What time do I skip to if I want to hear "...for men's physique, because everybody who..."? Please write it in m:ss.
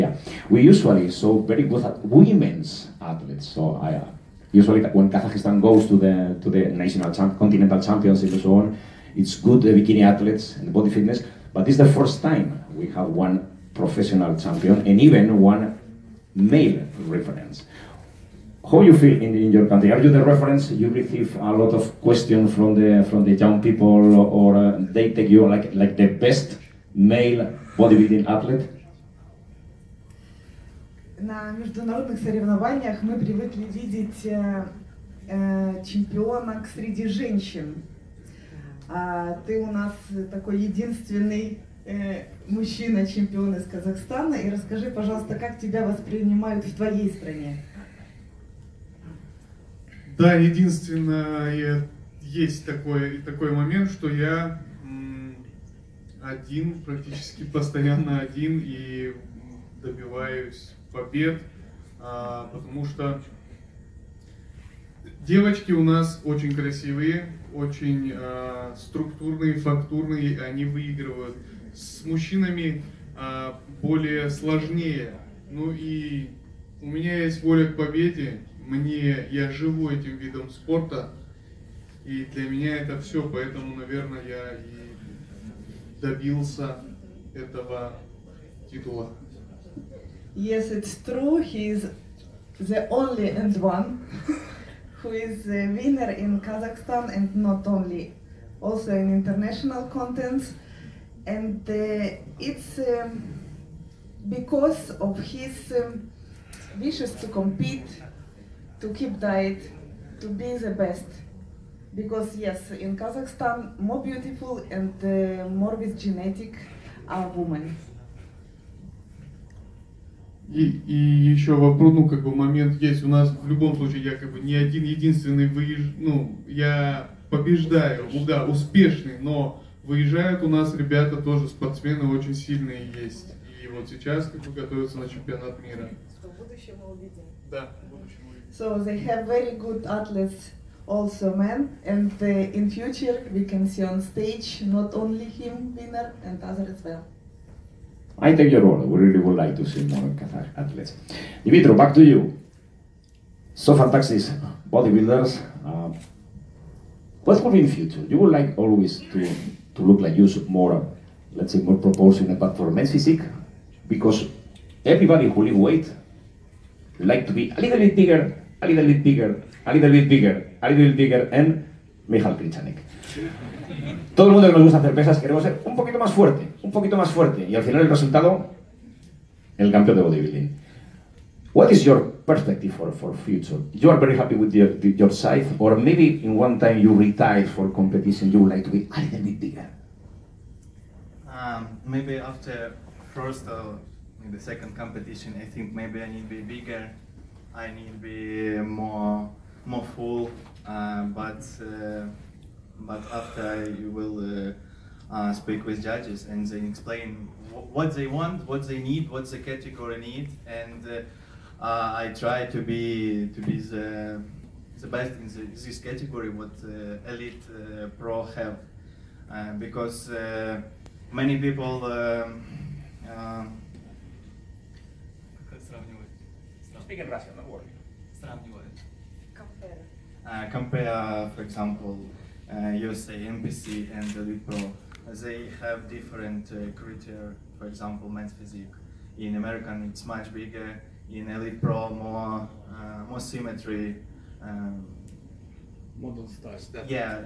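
2:42.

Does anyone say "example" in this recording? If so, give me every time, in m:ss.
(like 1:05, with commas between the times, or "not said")
3:51, 3:57.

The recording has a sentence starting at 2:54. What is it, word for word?
Todo el mundo que nos gusta hacer pesas queremos ser un poquito más fuerte, un poquito más fuerte.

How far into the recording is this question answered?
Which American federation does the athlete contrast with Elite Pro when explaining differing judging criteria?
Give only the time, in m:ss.
3:53.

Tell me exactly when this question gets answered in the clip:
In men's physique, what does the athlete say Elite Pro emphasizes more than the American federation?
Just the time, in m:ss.
4:03.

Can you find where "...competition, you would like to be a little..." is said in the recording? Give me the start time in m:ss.
3:07.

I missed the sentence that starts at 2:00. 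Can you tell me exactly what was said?
И, и еще вопрос, ну, ну, как бы момент есть.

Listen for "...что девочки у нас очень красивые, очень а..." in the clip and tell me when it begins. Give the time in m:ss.
1:02.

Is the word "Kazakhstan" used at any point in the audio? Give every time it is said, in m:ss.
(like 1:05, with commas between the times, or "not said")
0:05, 1:36, 1:52.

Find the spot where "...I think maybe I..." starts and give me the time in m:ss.
3:15.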